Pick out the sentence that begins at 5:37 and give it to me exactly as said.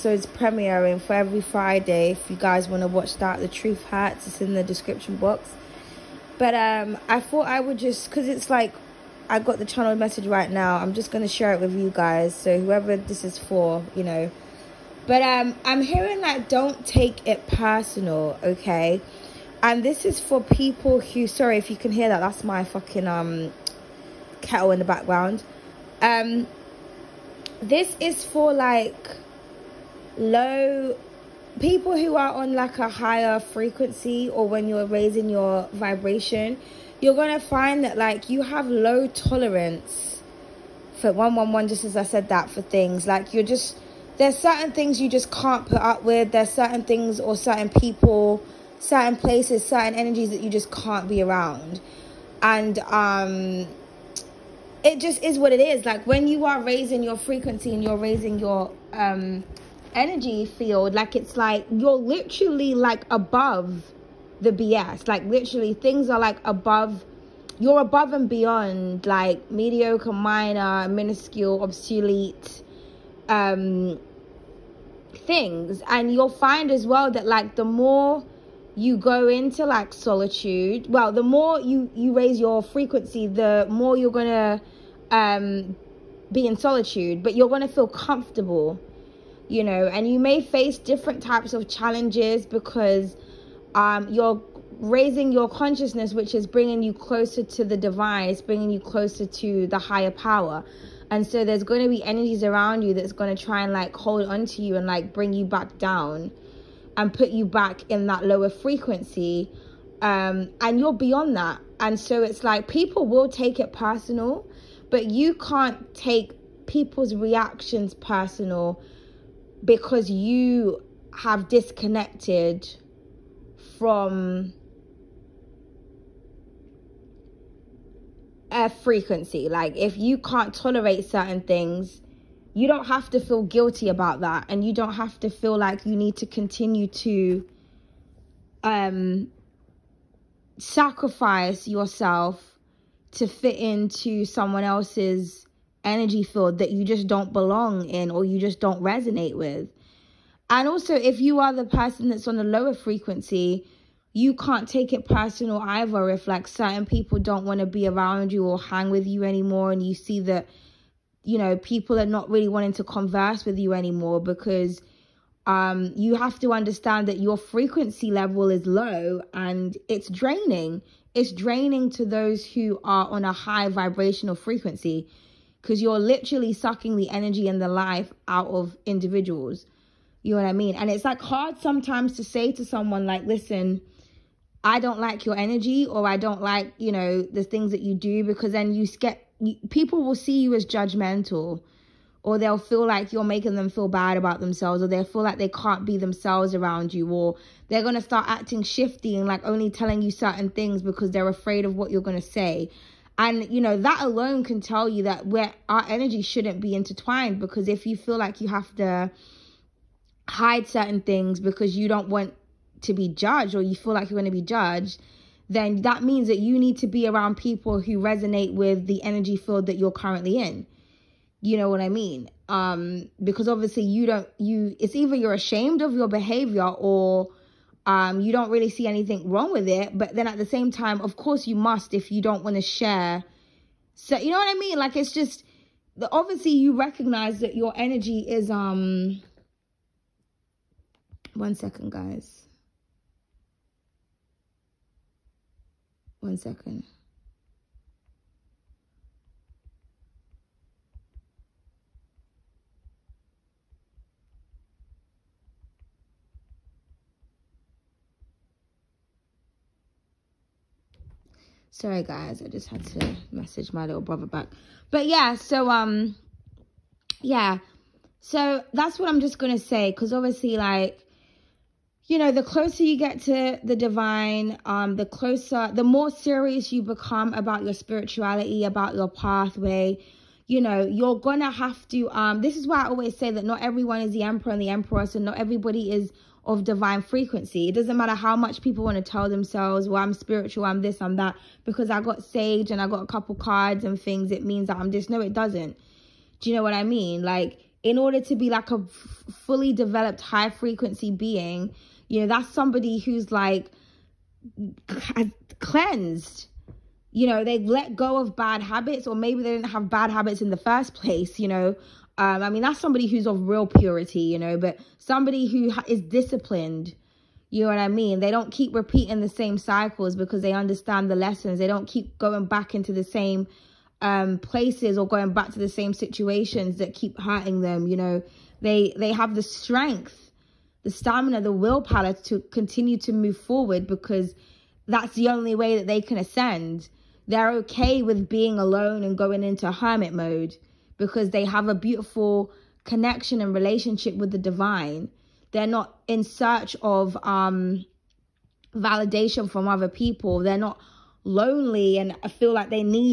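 They're okay with being alone and going into hermit mode because they have a beautiful connection and relationship with the divine.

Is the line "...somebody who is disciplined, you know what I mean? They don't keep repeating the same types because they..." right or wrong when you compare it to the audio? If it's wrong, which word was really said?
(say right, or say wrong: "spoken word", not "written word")
wrong: "cycles", not "types".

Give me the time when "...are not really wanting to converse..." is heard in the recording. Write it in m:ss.
2:41.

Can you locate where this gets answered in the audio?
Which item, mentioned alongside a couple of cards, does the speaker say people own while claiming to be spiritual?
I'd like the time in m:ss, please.
4:52.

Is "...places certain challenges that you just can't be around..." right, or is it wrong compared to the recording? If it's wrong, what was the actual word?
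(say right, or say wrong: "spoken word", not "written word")
wrong: "energies", not "challenges".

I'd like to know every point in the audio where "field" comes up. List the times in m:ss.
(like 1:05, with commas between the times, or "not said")
1:00, 2:26, 3:39.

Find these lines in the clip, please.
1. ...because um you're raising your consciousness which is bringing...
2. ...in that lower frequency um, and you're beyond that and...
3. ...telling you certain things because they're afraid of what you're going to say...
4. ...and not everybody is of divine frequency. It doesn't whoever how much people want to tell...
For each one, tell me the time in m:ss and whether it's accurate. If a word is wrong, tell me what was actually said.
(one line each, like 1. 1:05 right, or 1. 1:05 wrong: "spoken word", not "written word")
1. 1:32 right
2. 1:47 right
3. 3:19 right
4. 4:45 wrong: "matter", not "whoever".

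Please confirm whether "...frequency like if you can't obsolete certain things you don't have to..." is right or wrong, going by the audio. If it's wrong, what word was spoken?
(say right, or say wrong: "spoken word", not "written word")
wrong: "tolerate", not "obsolete".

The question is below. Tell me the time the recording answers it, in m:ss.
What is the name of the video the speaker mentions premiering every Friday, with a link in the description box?
0:03.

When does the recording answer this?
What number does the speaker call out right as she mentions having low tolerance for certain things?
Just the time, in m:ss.
0:41.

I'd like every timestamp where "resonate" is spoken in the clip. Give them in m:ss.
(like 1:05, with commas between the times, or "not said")
2:28, 3:37.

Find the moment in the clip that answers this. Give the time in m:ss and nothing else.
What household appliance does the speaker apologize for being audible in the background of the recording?
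0:24.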